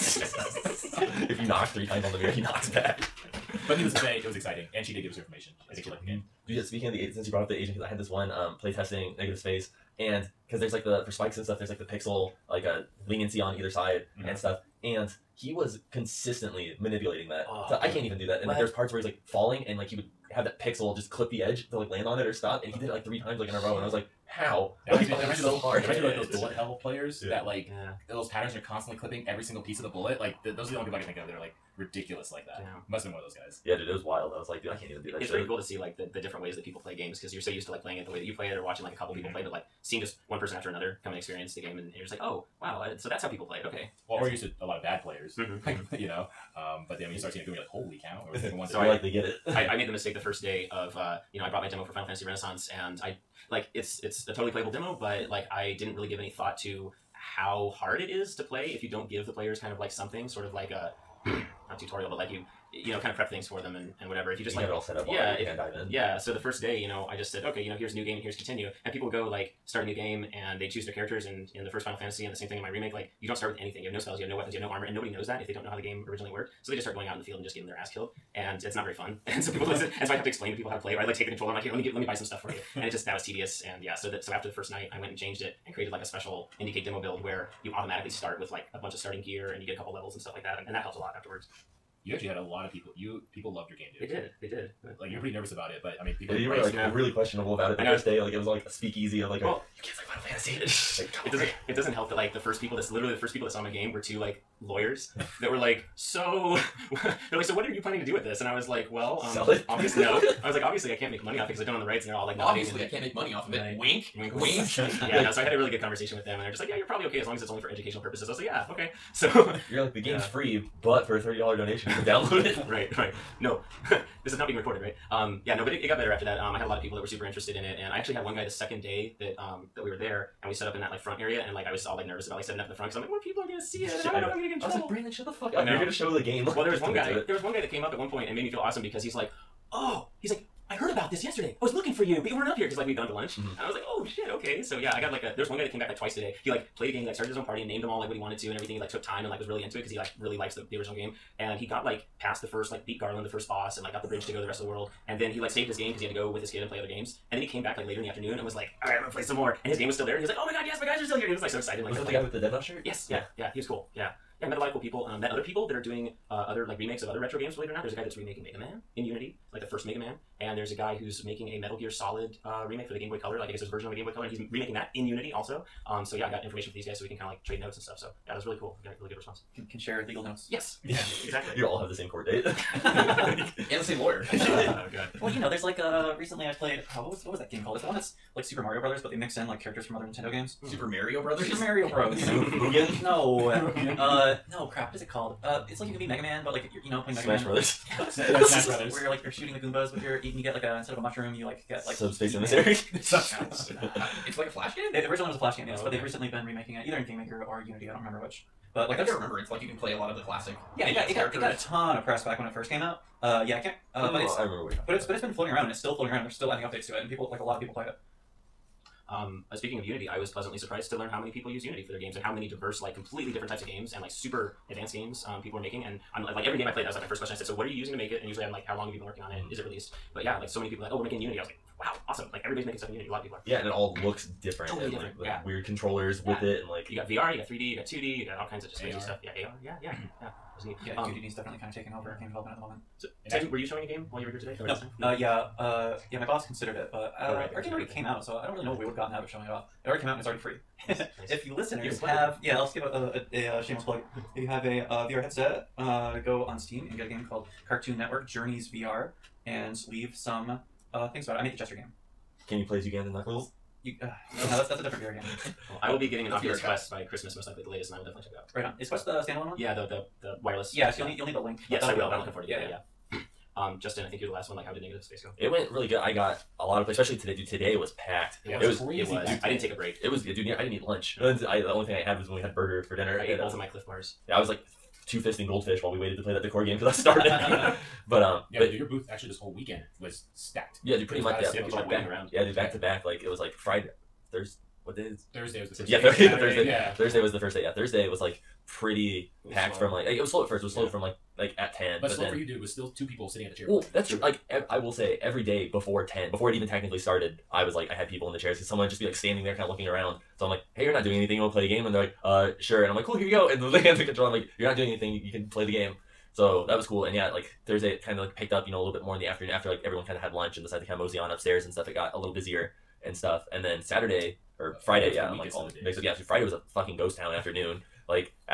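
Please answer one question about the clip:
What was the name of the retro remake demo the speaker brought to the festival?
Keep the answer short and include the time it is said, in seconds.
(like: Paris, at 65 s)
Final Fantasy Renaissance, at 51 s.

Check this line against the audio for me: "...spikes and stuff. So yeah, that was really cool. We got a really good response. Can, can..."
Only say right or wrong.
wrong.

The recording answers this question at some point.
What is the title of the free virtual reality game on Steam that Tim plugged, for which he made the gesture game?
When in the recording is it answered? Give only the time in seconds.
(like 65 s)
257 s.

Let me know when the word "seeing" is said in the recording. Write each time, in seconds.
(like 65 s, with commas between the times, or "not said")
39 s, 47 s.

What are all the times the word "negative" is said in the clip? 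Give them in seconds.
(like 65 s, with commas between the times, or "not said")
9 s, 274 s.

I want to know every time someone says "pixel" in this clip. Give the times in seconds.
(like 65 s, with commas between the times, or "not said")
11 s, 20 s.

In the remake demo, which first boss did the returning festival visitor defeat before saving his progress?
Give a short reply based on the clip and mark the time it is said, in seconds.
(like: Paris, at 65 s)
Garland, at 152 s.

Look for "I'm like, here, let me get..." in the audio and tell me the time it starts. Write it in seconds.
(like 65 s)
81 s.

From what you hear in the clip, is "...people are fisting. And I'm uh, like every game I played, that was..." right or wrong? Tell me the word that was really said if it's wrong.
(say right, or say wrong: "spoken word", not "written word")
wrong: "making", not "fisting".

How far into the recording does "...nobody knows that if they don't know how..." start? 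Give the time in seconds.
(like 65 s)
74 s.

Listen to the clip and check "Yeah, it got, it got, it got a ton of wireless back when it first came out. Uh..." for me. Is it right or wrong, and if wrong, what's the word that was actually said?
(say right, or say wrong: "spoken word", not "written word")
wrong: "press", not "wireless".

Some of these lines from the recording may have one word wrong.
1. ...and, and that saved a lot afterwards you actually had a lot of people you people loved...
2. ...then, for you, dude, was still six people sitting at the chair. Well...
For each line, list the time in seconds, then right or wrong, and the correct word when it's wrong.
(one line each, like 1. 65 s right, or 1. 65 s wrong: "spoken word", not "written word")
1. 90 s wrong: "helped", not "saved"
2. 302 s wrong: "two", not "six".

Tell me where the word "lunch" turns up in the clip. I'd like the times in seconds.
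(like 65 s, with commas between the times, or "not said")
143 s, 280 s, 320 s.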